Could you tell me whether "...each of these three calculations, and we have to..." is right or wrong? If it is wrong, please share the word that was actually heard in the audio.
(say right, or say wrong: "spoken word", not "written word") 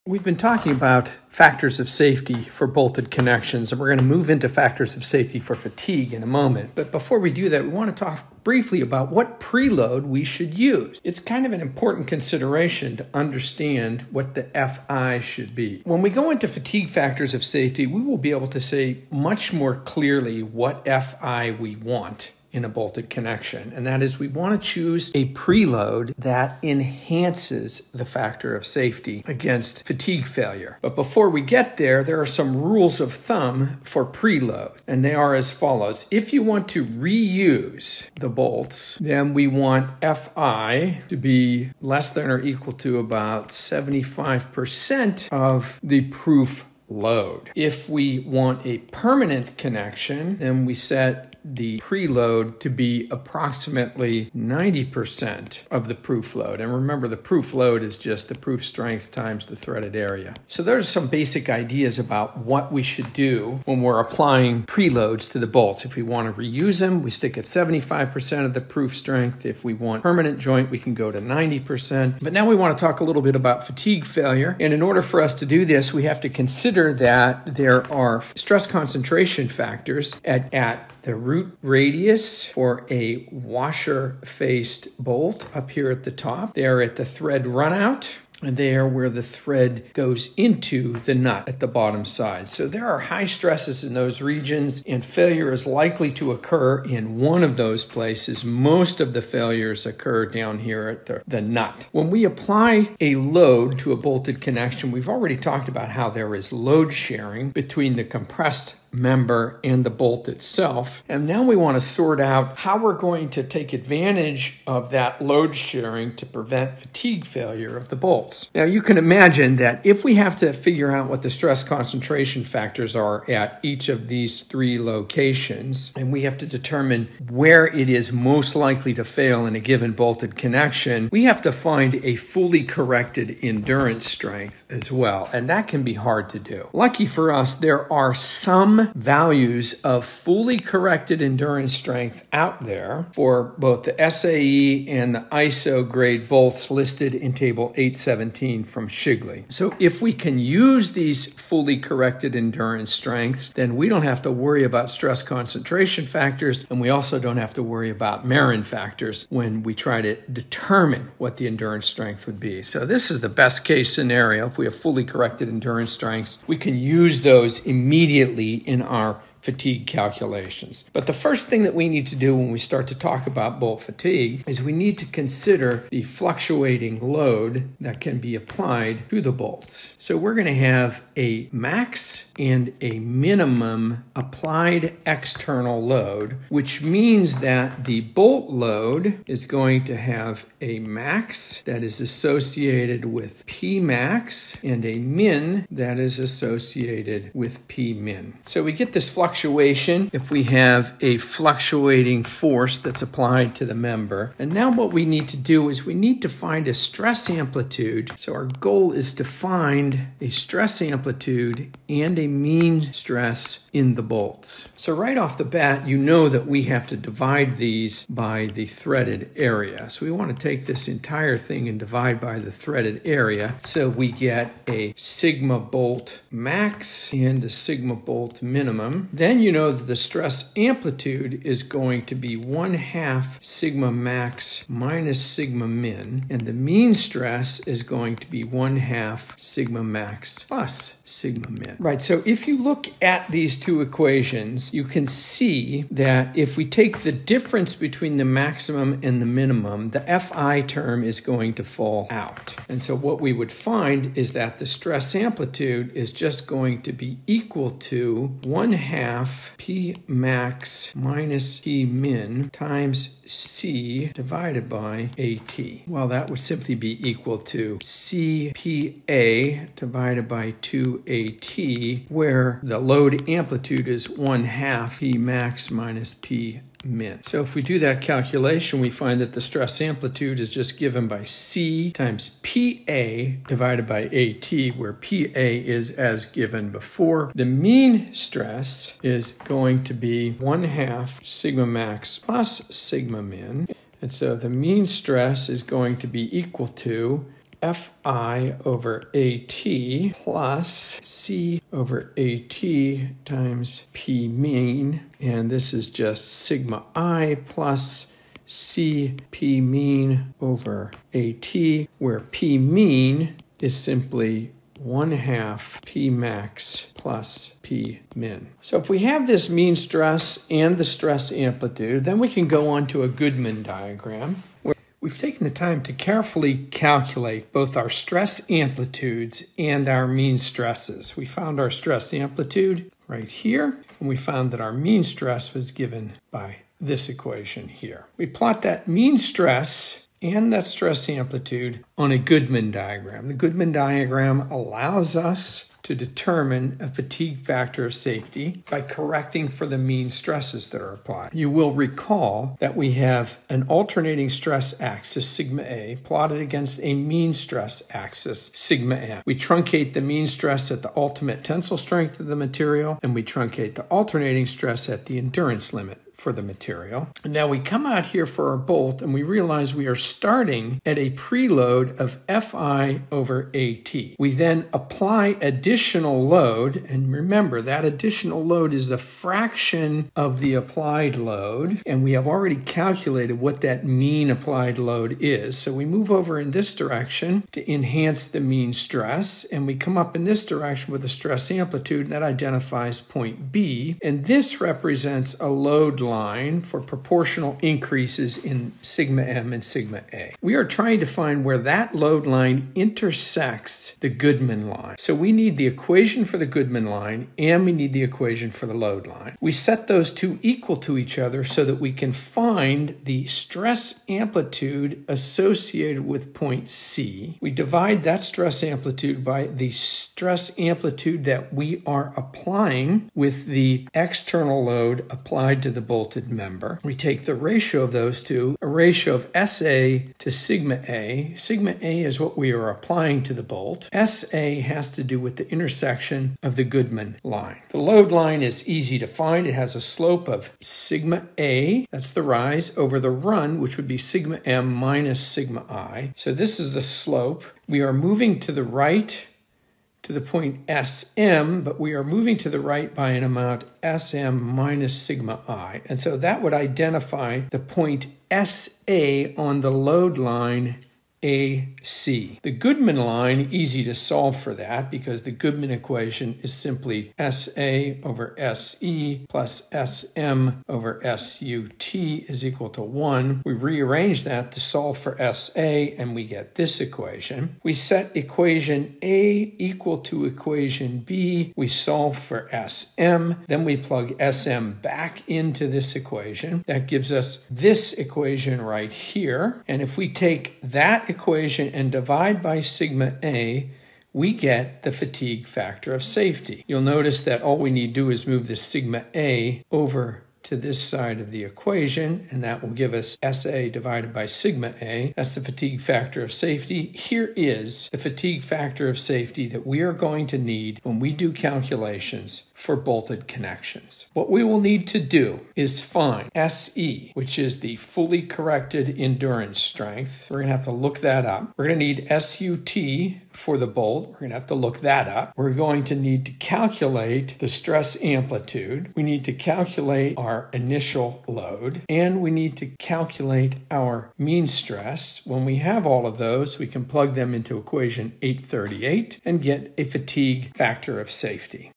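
wrong: "locations", not "calculations".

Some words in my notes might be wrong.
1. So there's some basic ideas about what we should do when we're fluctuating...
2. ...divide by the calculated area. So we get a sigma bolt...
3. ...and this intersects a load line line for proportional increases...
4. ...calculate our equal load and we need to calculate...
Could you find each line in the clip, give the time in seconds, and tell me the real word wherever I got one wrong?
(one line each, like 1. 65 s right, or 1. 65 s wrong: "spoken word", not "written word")
1. 60 s wrong: "applying", not "fluctuating"
2. 221 s wrong: "threaded", not "calculated"
3. 394 s wrong: "represents", not "intersects"
4. 529 s wrong: "initial", not "equal".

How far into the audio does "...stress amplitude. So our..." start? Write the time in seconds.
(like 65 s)
206 s.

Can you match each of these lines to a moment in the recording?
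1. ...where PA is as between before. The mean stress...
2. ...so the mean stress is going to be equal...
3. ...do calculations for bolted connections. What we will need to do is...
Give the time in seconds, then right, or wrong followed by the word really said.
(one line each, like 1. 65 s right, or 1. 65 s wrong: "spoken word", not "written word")
1. 284 s wrong: "given", not "between"
2. 294 s right
3. 511 s right.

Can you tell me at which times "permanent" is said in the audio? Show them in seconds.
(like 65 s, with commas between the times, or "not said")
48 s, 70 s.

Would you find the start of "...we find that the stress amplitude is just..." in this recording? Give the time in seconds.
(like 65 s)
278 s.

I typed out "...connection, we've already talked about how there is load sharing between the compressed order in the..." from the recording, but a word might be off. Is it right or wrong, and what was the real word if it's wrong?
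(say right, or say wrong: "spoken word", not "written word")
wrong: "member", not "order".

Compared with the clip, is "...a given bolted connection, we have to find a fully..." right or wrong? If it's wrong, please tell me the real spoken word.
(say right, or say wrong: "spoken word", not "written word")
right.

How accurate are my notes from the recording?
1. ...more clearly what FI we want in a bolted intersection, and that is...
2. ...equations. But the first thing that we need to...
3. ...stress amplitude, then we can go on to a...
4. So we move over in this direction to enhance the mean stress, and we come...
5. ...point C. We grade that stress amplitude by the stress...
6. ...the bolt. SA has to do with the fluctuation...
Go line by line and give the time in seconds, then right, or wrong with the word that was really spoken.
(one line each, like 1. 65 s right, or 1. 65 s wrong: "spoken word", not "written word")
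1. 19 s wrong: "connection", not "intersection"
2. 169 s wrong: "calculations", not "equations"
3. 320 s right
4. 385 s right
5. 416 s wrong: "divide", not "grade"
6. 433 s wrong: "intersection", not "fluctuation".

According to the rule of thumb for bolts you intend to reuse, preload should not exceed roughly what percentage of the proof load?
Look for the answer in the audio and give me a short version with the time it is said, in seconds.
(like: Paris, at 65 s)
75%, at 43 s.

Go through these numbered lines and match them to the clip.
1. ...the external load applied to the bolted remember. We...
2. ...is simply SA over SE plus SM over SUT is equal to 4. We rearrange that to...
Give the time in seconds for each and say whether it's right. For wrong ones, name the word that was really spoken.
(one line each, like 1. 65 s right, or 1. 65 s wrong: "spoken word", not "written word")
1. 423 s wrong: "member", not "remember"
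2. 466 s wrong: "1", not "4".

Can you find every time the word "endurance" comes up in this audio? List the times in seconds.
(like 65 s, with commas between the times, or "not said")
133 s, 141 s, 152 s, 161 s, 165 s, 365 s, 518 s.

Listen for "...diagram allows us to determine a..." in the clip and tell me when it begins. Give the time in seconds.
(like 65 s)
343 s.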